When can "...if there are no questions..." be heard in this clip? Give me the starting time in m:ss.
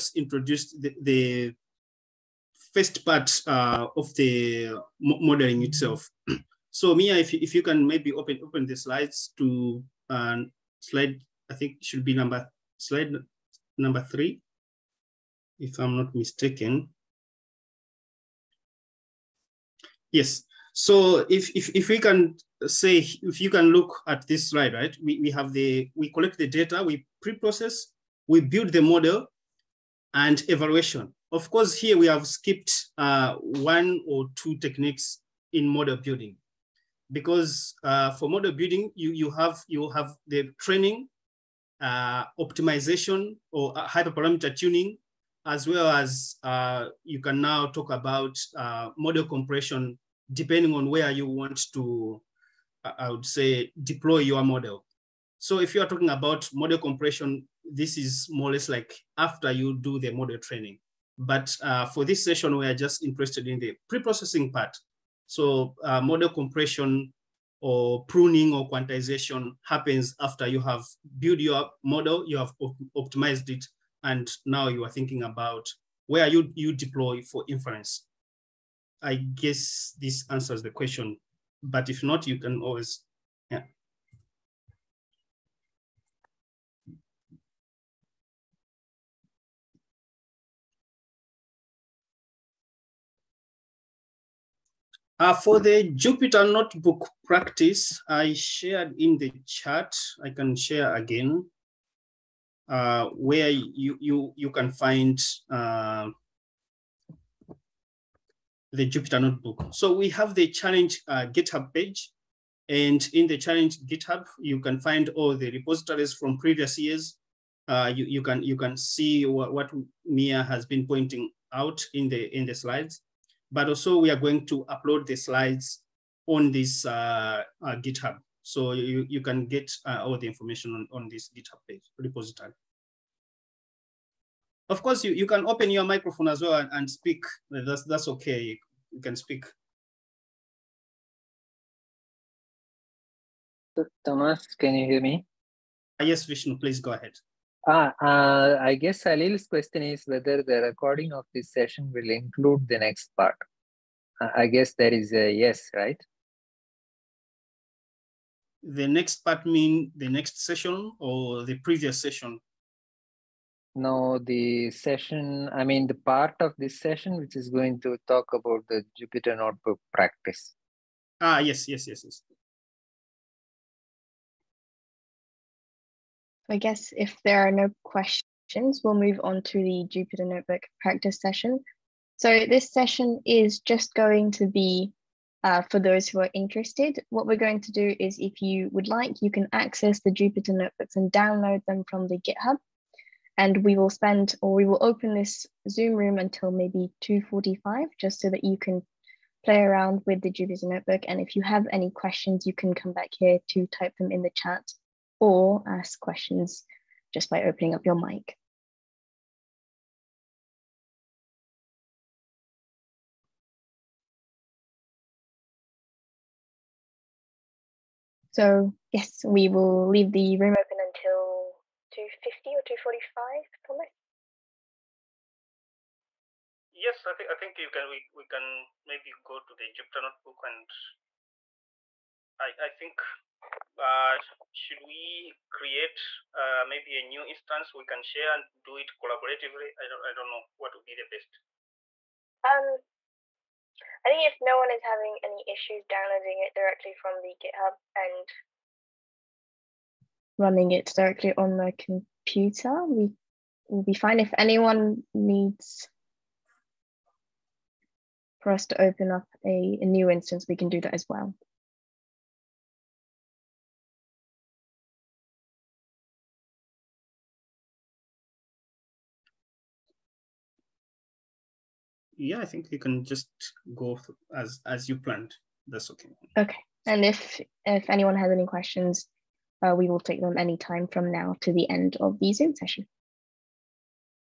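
2:56.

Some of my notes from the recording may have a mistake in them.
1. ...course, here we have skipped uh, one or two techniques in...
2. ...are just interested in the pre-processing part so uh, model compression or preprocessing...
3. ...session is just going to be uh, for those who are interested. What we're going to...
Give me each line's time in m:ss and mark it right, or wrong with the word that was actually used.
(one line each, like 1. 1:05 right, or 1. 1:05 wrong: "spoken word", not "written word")
1. 0:31 right
2. 1:02 wrong: "pruning", not "preprocessing"
3. 3:02 right.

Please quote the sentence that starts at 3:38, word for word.
So yes, we will leave the room open until 2.50 or 2.45, promise?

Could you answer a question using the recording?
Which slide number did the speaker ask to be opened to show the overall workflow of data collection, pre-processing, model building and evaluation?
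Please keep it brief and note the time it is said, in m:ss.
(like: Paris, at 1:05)
3, at 0:12.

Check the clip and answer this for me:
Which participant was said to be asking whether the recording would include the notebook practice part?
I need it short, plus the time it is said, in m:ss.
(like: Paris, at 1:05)
Salil, at 2:29.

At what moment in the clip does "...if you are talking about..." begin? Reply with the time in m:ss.
0:55.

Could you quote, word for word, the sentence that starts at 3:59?
I don't, I don't know what would be the best.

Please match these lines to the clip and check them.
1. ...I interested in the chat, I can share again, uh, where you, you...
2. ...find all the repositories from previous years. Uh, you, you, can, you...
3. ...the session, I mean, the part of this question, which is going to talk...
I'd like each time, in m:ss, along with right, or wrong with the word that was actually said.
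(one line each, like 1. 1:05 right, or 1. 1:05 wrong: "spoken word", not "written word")
1. 1:38 wrong: "shared", not "interested"
2. 1:54 right
3. 2:44 wrong: "session", not "question".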